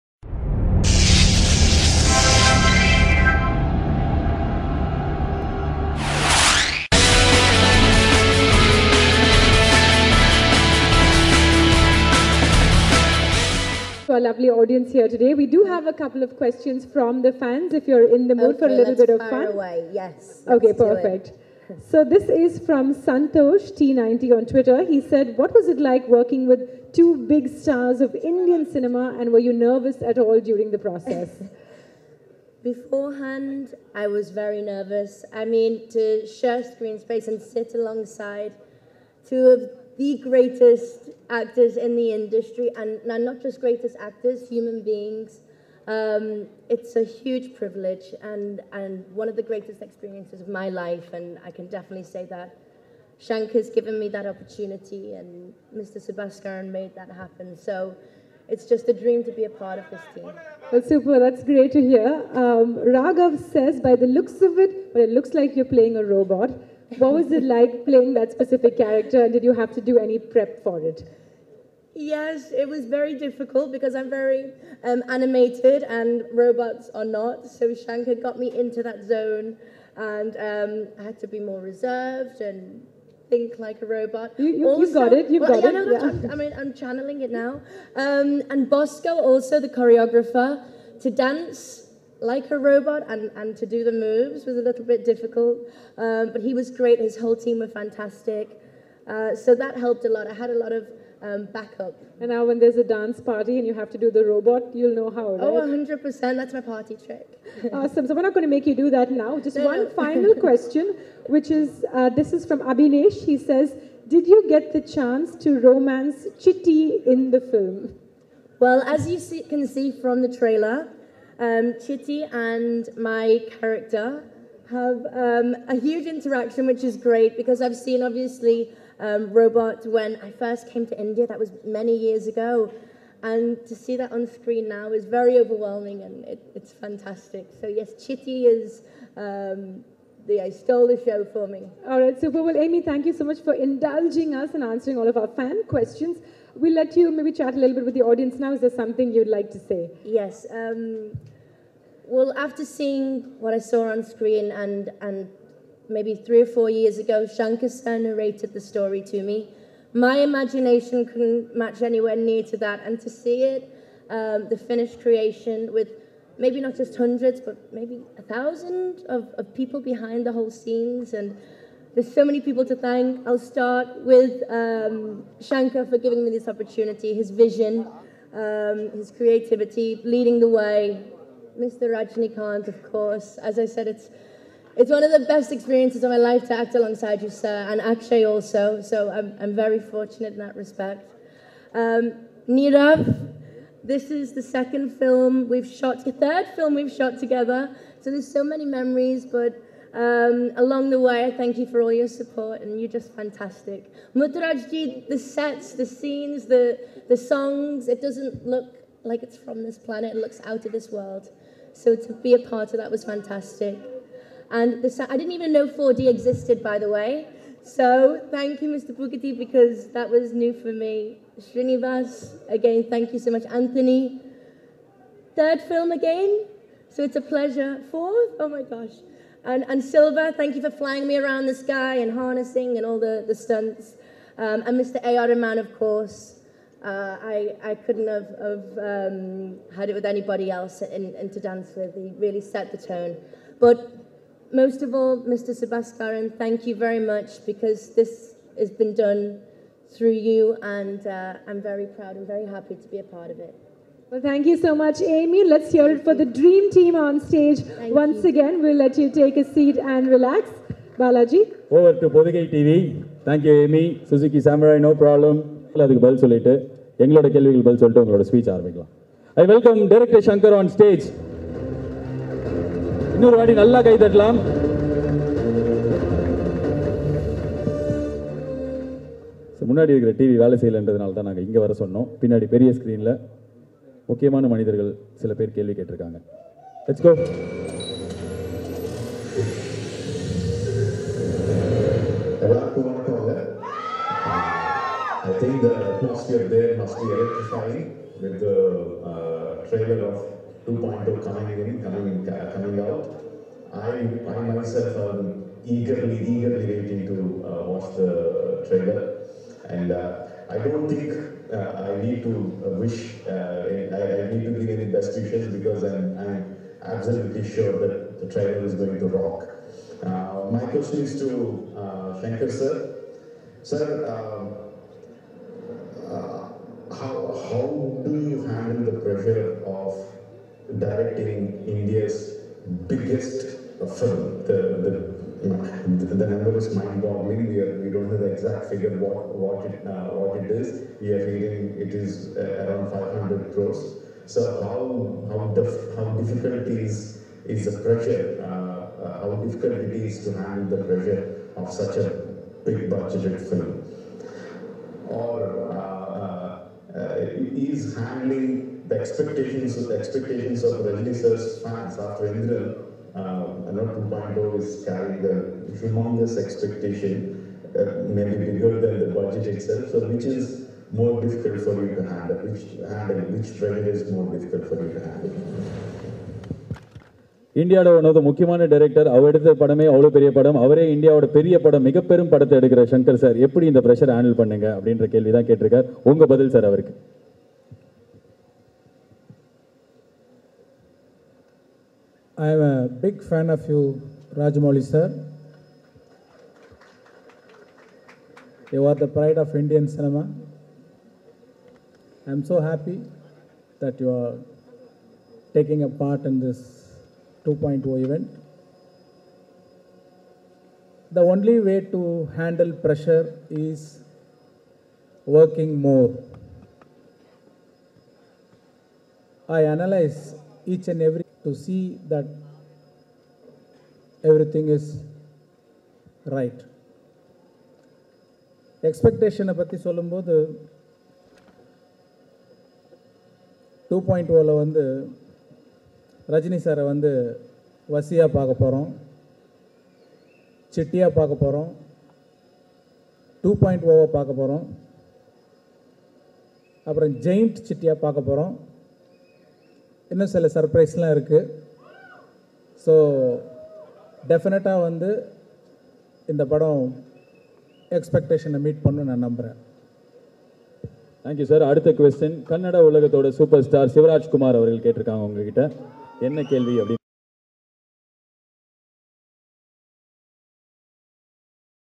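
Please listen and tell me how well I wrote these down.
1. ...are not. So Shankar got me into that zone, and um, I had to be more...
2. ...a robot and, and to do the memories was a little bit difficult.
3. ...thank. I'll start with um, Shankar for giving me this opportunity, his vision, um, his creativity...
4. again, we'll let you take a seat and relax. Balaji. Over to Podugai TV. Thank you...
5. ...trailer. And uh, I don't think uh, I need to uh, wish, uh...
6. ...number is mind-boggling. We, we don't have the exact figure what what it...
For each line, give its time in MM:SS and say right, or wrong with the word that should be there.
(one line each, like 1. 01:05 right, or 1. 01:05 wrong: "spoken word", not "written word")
1. 01:16 right
2. 01:32 wrong: "moves", not "memories"
3. 02:52 right
4. 04:18 right
5. 05:08 right
6. 05:36 right.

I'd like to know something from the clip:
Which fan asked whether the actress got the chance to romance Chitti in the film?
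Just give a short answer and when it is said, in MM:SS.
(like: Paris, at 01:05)
Abhinesh, at 01:52.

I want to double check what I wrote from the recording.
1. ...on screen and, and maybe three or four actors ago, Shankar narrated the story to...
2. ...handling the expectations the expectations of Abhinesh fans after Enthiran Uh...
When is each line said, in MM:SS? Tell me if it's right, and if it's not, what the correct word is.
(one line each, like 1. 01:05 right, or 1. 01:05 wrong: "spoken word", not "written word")
1. 02:33 wrong: "years", not "actors"
2. 05:57 wrong: "Rajni", not "Abhinesh".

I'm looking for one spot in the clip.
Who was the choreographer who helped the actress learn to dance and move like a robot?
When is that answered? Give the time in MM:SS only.
01:28.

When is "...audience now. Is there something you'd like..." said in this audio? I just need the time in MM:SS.
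02:28.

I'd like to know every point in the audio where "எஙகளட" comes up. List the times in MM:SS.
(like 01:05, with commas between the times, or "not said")
04:27.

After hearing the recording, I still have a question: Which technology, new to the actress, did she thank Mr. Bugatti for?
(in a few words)
4D.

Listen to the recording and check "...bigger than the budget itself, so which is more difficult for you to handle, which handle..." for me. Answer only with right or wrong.
right.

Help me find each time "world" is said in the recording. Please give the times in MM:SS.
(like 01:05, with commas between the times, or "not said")
03:30.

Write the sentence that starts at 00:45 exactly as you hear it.
Um, it's a huge privilege and, and one of the greatest experiences of my life, and I can definitely say that.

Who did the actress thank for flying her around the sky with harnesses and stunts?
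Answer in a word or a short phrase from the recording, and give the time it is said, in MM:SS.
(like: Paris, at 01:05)
Silva, at 03:49.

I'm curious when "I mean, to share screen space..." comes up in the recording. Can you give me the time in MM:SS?
00:35.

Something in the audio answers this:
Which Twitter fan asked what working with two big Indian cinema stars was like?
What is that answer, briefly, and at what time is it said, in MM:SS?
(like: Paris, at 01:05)
Santosh T90, at 00:22.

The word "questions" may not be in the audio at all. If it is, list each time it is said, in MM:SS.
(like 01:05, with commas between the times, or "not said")
00:16, 01:50, 02:25, 05:20.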